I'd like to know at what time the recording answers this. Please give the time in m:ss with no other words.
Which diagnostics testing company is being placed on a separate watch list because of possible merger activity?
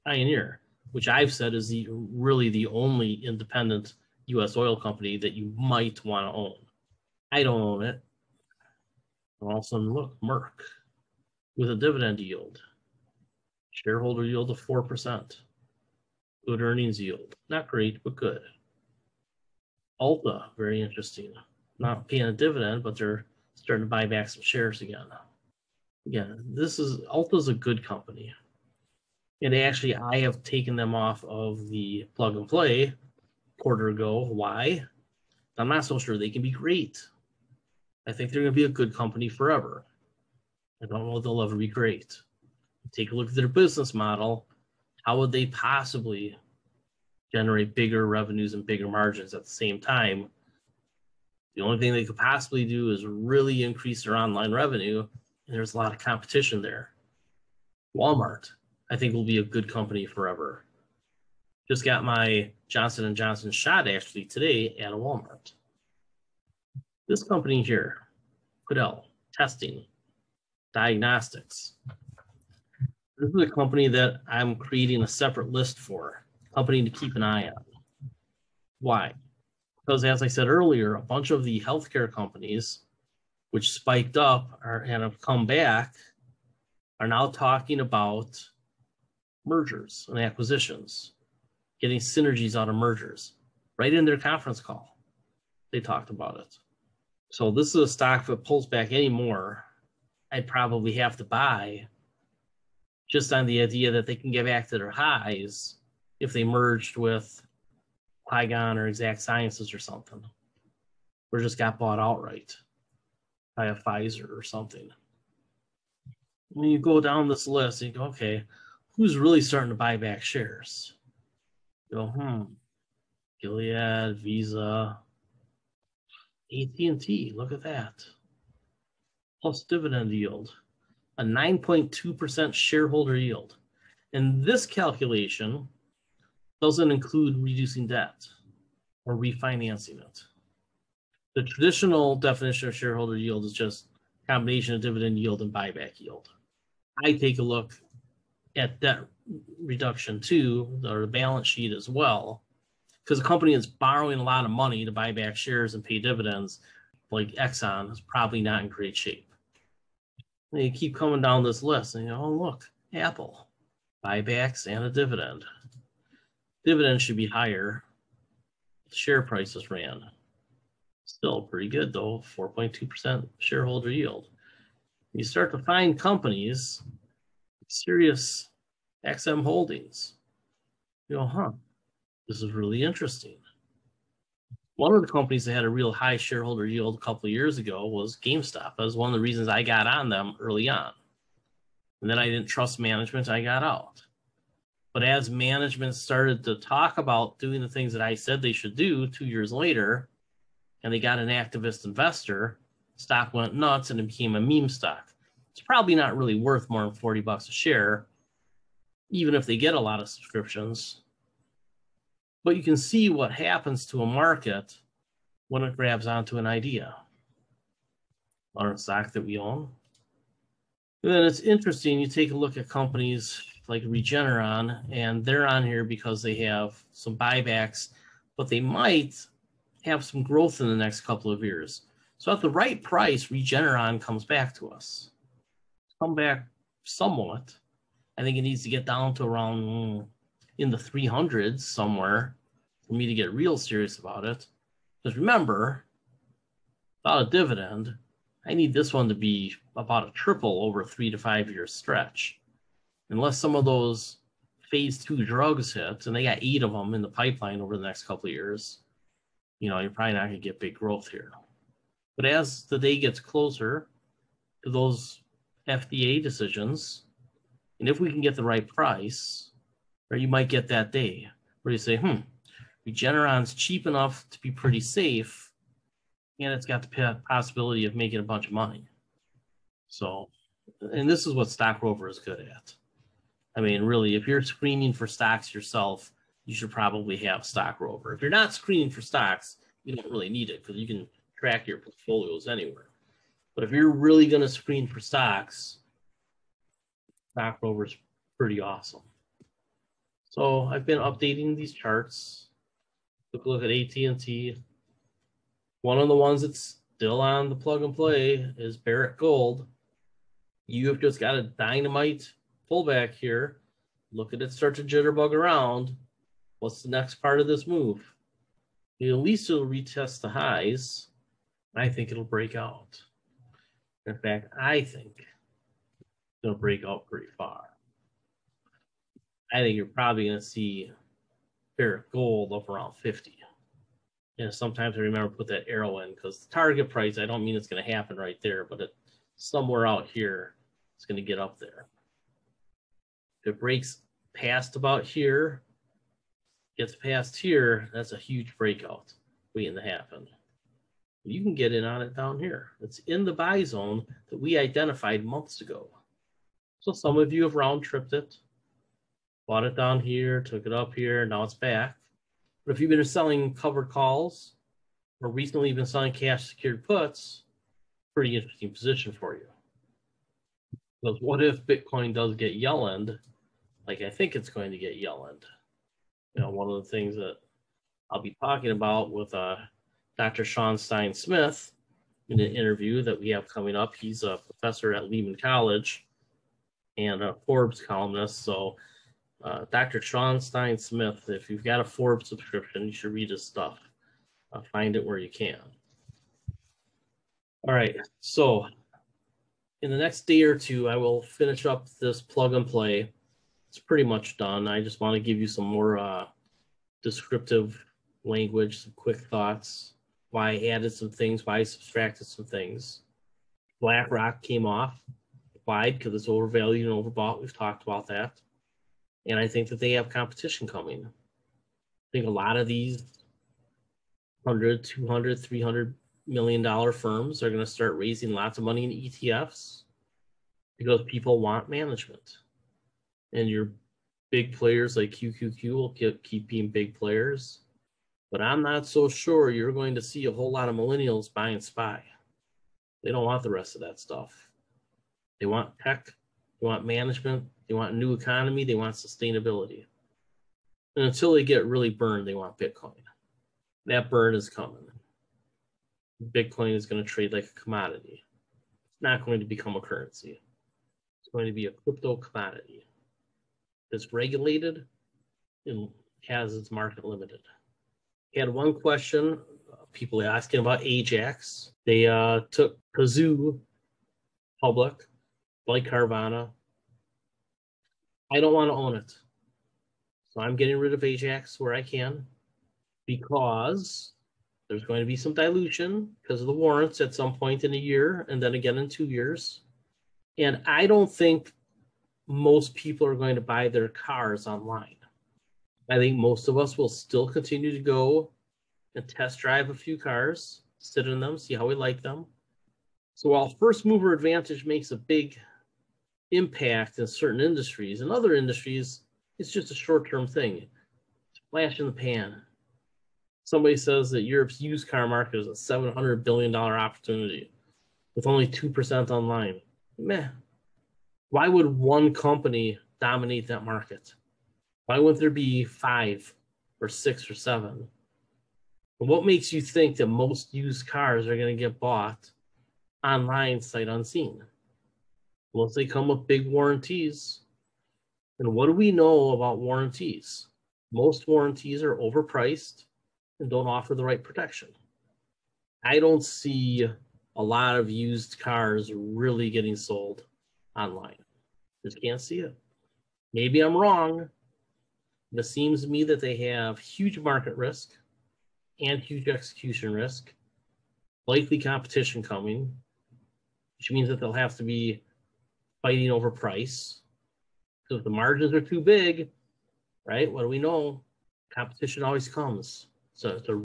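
1:08.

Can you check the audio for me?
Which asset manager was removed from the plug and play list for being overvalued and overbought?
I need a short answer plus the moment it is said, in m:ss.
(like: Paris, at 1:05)
BlackRock, at 6:53.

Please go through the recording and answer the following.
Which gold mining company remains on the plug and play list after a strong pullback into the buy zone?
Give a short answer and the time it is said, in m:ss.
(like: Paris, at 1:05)
Barrick Gold, at 5:08.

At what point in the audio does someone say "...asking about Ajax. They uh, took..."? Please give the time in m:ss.
7:50.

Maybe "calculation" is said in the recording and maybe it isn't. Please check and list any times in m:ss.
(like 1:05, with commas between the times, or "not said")
2:14.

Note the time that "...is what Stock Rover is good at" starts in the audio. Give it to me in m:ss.
4:41.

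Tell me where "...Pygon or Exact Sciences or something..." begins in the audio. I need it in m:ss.
1:48.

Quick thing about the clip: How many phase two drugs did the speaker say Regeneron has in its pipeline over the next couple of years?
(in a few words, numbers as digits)
8.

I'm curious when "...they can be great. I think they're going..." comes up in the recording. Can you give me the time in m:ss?
0:36.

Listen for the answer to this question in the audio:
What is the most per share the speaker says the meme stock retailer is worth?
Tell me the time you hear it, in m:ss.
3:26.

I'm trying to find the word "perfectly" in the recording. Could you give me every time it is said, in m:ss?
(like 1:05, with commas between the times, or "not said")
not said.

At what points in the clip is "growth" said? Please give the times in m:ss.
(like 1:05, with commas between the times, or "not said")
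3:50, 4:20.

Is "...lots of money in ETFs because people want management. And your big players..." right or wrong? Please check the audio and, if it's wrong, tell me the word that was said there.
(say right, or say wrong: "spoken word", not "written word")
right.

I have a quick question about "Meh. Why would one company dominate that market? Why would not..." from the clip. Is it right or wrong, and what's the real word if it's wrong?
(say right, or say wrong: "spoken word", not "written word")
right.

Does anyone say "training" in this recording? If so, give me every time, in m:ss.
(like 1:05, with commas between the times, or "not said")
not said.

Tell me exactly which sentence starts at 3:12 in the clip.
And then I didn't trust management, I got out.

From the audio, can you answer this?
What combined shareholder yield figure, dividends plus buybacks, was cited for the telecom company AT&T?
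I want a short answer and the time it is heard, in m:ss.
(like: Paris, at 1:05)
9.2%, at 2:11.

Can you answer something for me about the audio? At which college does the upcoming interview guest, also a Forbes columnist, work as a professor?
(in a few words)
Lehman College.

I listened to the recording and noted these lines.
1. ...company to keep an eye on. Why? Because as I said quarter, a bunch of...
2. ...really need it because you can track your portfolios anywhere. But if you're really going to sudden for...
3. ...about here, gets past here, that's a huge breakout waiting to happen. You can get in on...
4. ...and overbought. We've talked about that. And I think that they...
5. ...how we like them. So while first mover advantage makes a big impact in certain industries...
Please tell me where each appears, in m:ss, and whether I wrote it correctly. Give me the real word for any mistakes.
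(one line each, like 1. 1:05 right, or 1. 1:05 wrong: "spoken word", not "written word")
1. 1:16 wrong: "earlier", not "quarter"
2. 4:50 wrong: "screen", not "sudden"
3. 5:44 right
4. 6:56 right
5. 8:21 right.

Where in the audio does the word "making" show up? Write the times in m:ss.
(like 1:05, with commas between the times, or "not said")
4:37.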